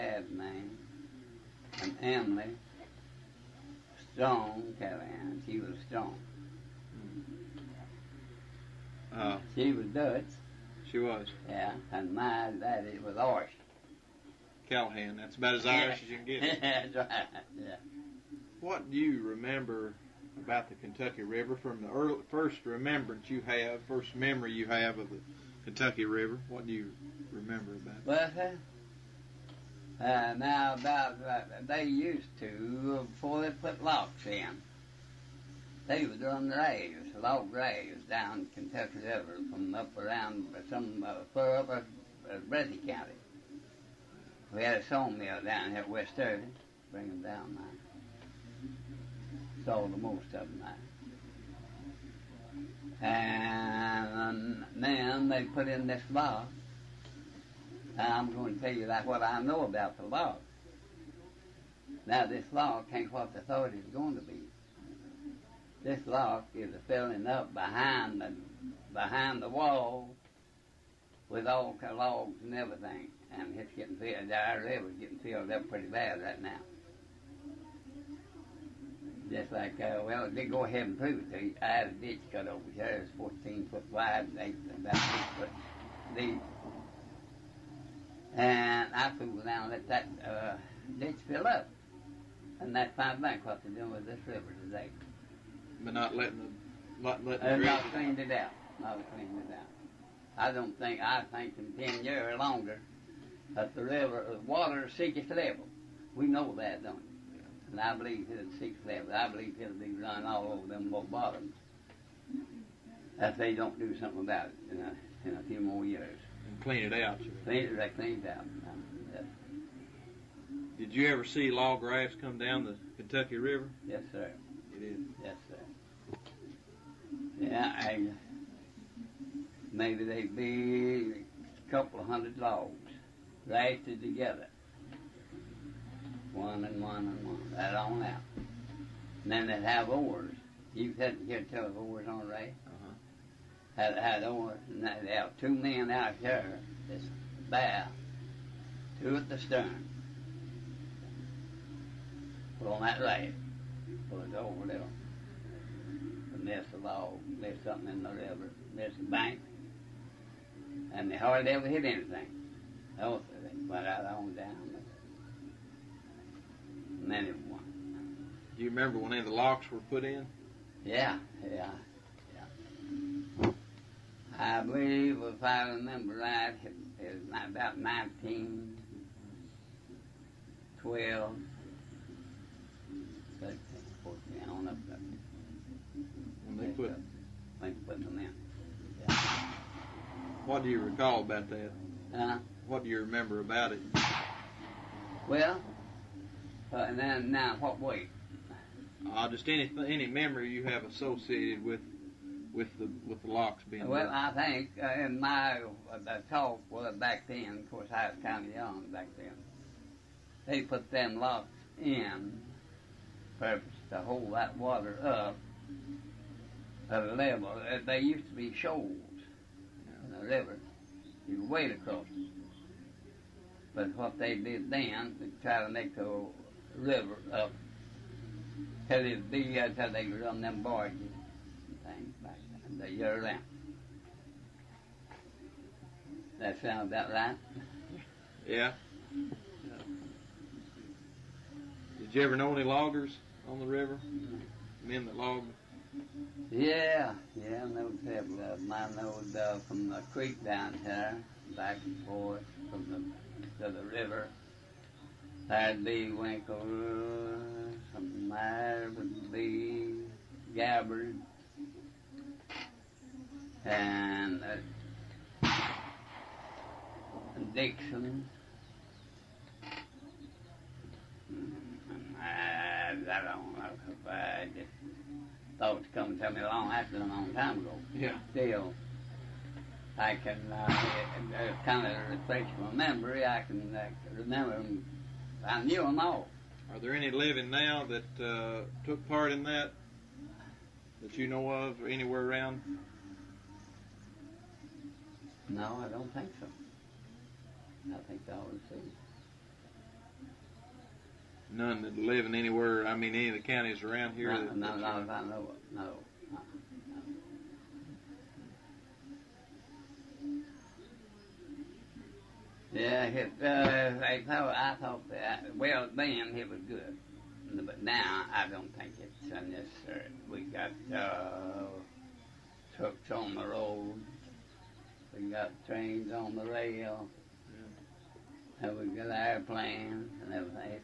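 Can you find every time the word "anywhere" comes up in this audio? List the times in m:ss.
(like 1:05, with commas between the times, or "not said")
4:51, 5:02.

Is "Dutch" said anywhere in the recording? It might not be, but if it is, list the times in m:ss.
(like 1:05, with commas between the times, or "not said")
0:09.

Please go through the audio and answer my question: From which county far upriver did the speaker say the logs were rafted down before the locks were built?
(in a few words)
Breathitt County.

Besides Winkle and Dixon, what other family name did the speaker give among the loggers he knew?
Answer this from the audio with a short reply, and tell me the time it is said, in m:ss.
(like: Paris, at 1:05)
Gabbard, at 4:20.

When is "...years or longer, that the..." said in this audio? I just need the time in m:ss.
1:42.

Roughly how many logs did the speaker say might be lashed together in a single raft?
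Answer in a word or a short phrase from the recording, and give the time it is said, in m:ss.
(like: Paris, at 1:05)
a couple of hundred, at 2:11.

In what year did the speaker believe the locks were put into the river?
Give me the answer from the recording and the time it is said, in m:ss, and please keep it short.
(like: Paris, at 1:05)
1912, at 2:57.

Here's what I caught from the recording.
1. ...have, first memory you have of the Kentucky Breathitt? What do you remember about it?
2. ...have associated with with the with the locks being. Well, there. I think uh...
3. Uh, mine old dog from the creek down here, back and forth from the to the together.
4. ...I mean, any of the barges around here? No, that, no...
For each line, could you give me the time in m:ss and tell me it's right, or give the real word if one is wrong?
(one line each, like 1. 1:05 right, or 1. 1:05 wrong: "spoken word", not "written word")
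1. 0:23 wrong: "River", not "Breathitt"
2. 3:20 right
3. 4:08 wrong: "river", not "together"
4. 5:02 wrong: "counties", not "barges".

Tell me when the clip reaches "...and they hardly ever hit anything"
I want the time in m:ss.
2:40.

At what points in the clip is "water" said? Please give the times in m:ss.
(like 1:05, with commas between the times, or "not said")
1:44, 3:34.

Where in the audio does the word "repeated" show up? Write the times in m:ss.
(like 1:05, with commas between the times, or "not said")
not said.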